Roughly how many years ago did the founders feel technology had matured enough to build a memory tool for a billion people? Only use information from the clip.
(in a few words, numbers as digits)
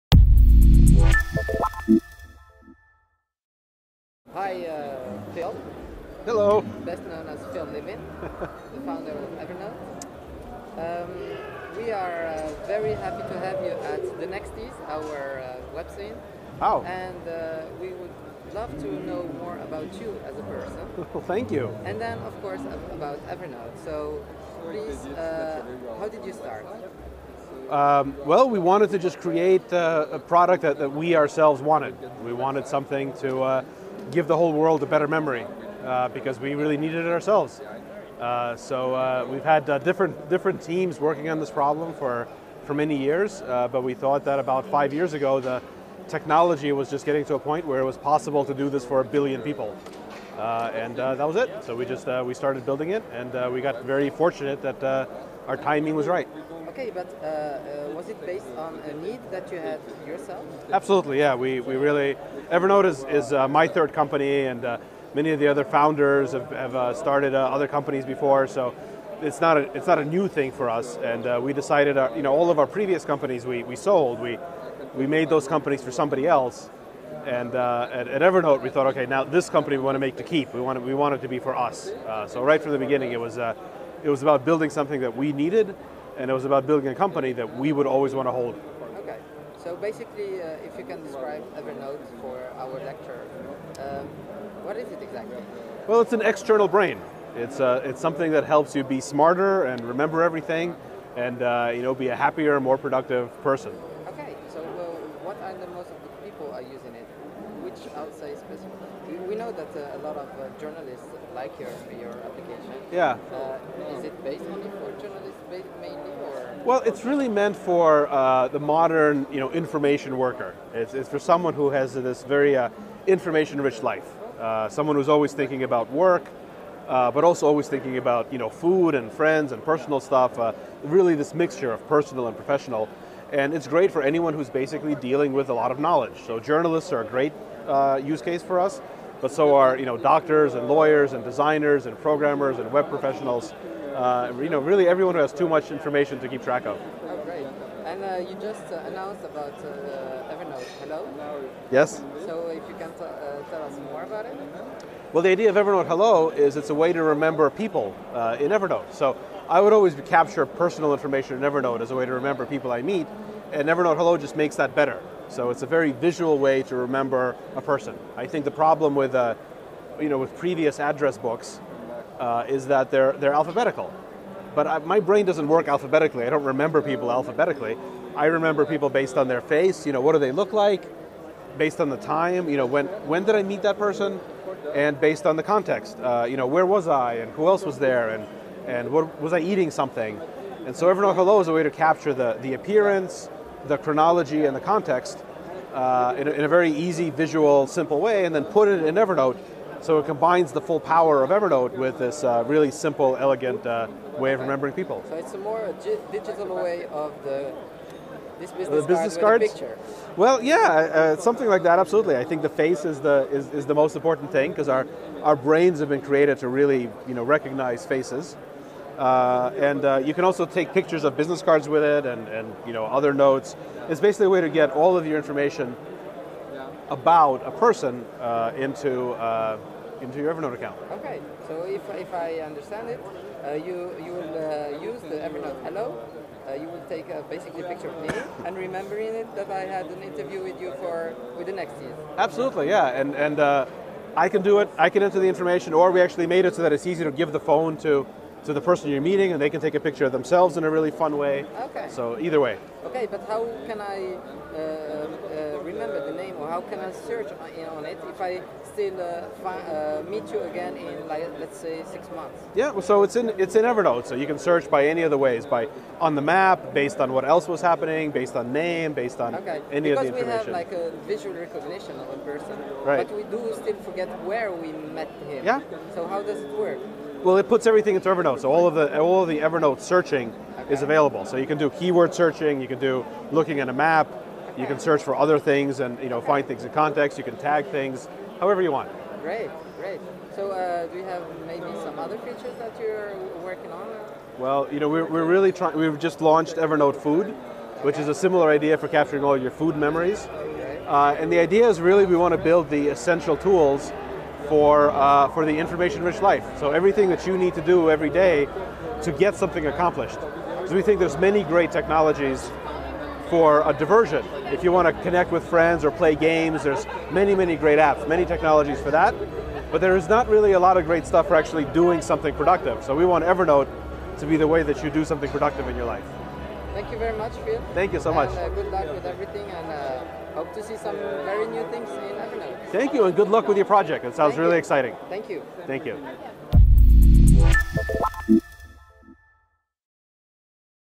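5.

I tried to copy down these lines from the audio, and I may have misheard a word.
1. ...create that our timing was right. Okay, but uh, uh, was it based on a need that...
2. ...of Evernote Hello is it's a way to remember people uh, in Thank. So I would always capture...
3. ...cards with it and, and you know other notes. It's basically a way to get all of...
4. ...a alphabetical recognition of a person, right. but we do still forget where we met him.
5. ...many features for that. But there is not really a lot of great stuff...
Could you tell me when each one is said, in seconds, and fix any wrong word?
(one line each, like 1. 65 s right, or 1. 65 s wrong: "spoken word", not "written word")
1. 54 s wrong: "fortunate", not "create"
2. 155 s wrong: "Evernote", not "Thank"
3. 221 s right
4. 270 s wrong: "visual", not "alphabetical"
5. 318 s wrong: "technologies", not "features".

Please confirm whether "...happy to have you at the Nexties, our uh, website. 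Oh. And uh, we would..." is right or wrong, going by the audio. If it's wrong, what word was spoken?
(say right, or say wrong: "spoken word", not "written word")
right.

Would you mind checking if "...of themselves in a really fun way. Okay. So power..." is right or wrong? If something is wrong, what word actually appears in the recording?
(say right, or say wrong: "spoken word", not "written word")
wrong: "either", not "power".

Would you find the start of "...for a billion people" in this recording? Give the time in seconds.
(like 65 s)
48 s.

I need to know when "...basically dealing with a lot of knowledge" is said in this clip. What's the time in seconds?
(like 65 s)
134 s.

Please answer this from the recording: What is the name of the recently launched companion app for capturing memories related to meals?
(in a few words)
Evernote Food.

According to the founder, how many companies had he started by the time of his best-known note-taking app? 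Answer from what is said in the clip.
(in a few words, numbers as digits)
3.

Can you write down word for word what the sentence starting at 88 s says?
Okay, so basically, uh, if you can describe Evernote for our lecture, uh, what is it exactly?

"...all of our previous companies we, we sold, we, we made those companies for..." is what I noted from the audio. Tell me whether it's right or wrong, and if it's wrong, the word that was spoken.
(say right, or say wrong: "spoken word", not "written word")
right.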